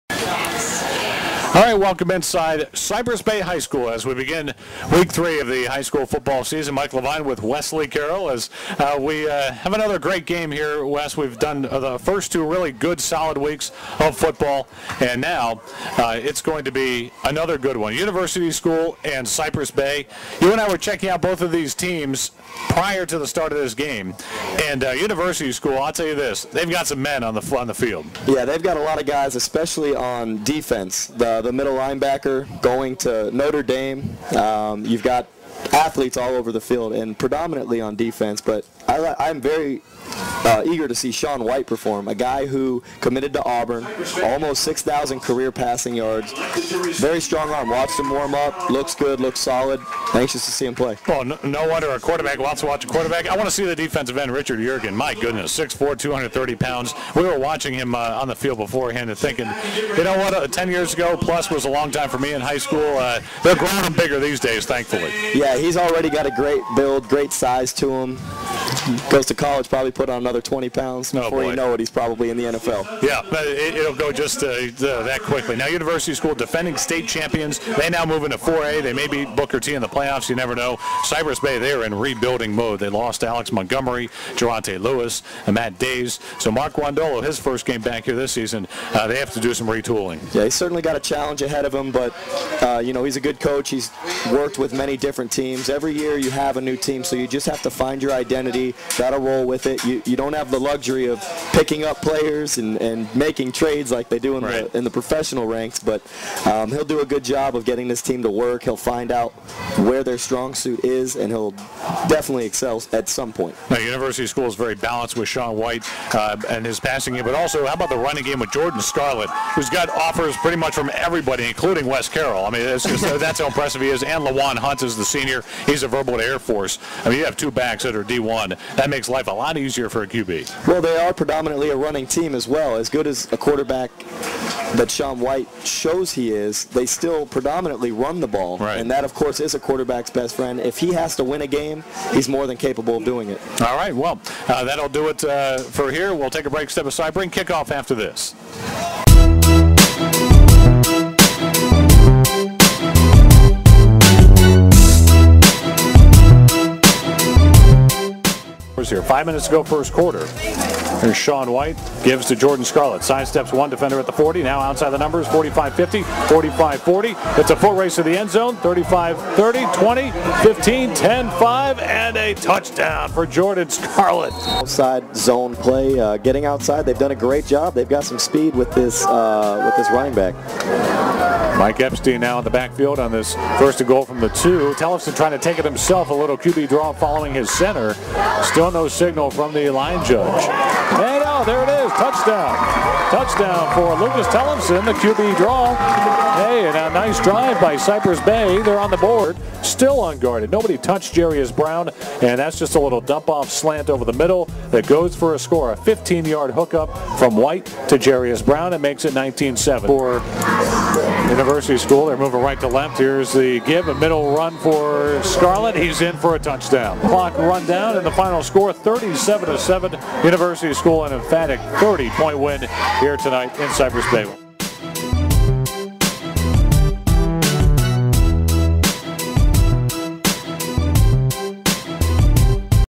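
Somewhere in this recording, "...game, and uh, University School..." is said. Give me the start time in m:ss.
0:23.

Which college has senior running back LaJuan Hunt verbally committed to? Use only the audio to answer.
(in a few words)
Air Force.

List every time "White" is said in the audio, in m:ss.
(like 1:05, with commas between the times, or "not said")
0:41, 1:55, 2:15, 2:41, 3:27.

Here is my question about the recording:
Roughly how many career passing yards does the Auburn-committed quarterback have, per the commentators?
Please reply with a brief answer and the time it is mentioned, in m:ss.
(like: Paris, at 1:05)
6,000, at 0:44.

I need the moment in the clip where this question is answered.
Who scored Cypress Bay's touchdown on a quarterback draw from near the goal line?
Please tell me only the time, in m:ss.
3:14.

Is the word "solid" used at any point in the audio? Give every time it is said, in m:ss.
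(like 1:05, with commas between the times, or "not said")
0:13, 0:49.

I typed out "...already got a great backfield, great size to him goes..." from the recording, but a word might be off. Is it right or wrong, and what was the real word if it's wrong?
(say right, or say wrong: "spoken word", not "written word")
wrong: "build", not "backfield".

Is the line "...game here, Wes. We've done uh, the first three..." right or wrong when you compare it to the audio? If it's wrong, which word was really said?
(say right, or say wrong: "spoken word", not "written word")
wrong: "two", not "three".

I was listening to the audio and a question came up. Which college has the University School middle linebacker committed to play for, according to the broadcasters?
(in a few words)
Notre Dame.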